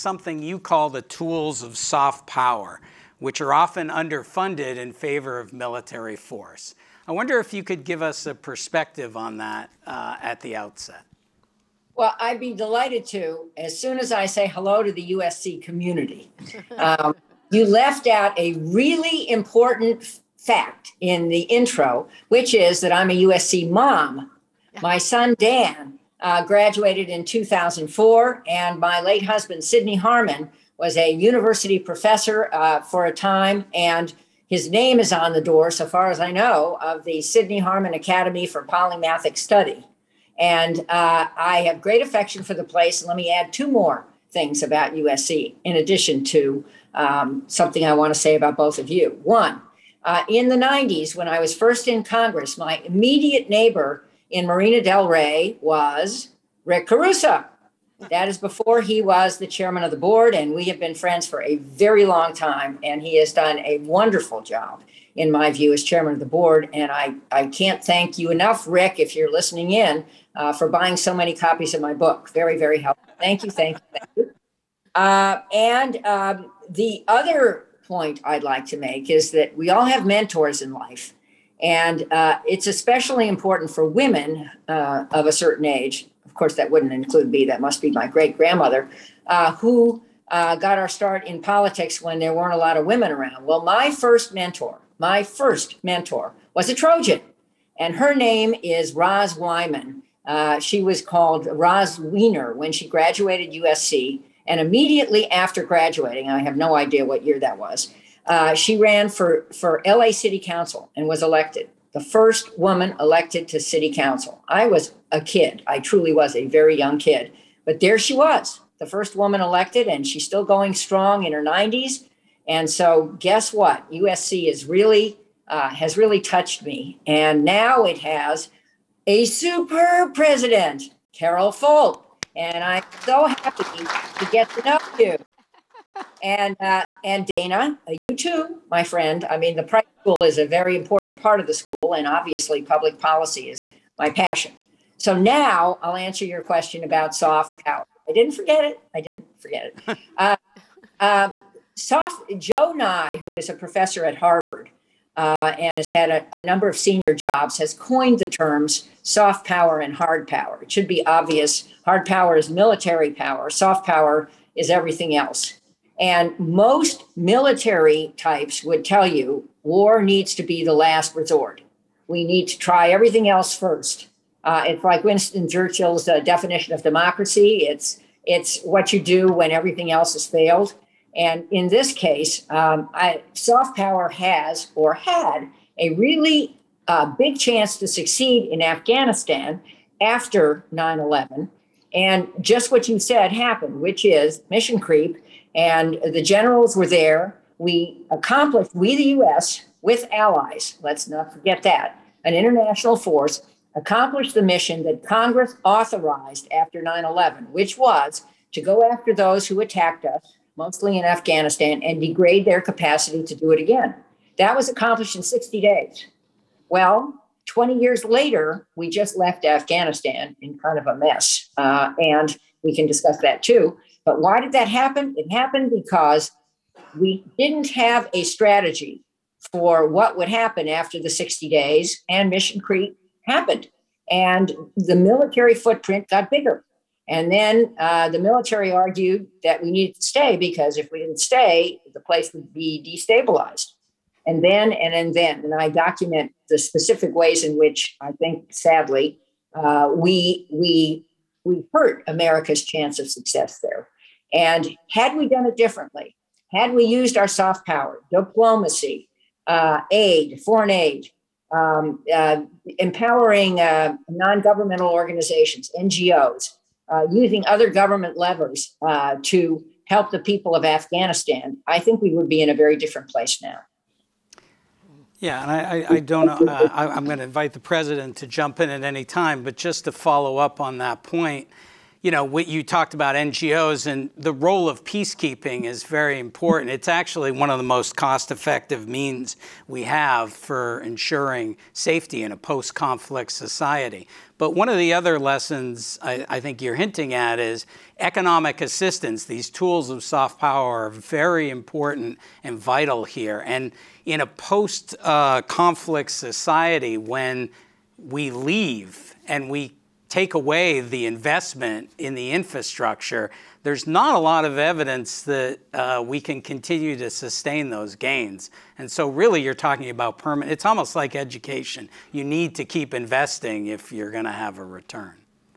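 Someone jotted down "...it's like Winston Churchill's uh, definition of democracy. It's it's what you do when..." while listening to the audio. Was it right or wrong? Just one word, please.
right.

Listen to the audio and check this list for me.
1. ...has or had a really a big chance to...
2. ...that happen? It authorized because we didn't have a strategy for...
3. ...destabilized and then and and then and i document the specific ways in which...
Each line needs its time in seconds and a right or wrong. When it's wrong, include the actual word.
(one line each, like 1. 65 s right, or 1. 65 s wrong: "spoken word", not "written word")
1. 184 s right
2. 224 s wrong: "happened", not "authorized"
3. 243 s right.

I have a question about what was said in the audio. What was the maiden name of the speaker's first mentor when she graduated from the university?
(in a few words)
Roz Wiener.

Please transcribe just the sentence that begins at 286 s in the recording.
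It's actually one of the most cost-effective means we have for ensuring safety in a post-conflict society.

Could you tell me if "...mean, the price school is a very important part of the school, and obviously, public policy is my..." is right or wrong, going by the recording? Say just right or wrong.
right.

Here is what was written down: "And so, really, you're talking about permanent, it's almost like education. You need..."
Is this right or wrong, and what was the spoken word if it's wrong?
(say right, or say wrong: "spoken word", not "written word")
right.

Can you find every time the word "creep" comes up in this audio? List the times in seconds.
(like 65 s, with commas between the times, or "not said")
194 s, 232 s.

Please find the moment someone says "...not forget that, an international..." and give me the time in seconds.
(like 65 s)
201 s.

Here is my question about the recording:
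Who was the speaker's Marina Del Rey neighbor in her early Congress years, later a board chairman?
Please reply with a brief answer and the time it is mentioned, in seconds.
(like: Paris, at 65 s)
Rick Caruso, at 56 s.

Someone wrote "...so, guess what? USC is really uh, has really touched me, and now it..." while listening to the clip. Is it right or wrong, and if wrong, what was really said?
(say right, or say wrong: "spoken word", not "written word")
right.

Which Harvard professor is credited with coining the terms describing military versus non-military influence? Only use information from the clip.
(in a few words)
Joe Nye.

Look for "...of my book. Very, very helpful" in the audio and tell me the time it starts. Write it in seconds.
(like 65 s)
71 s.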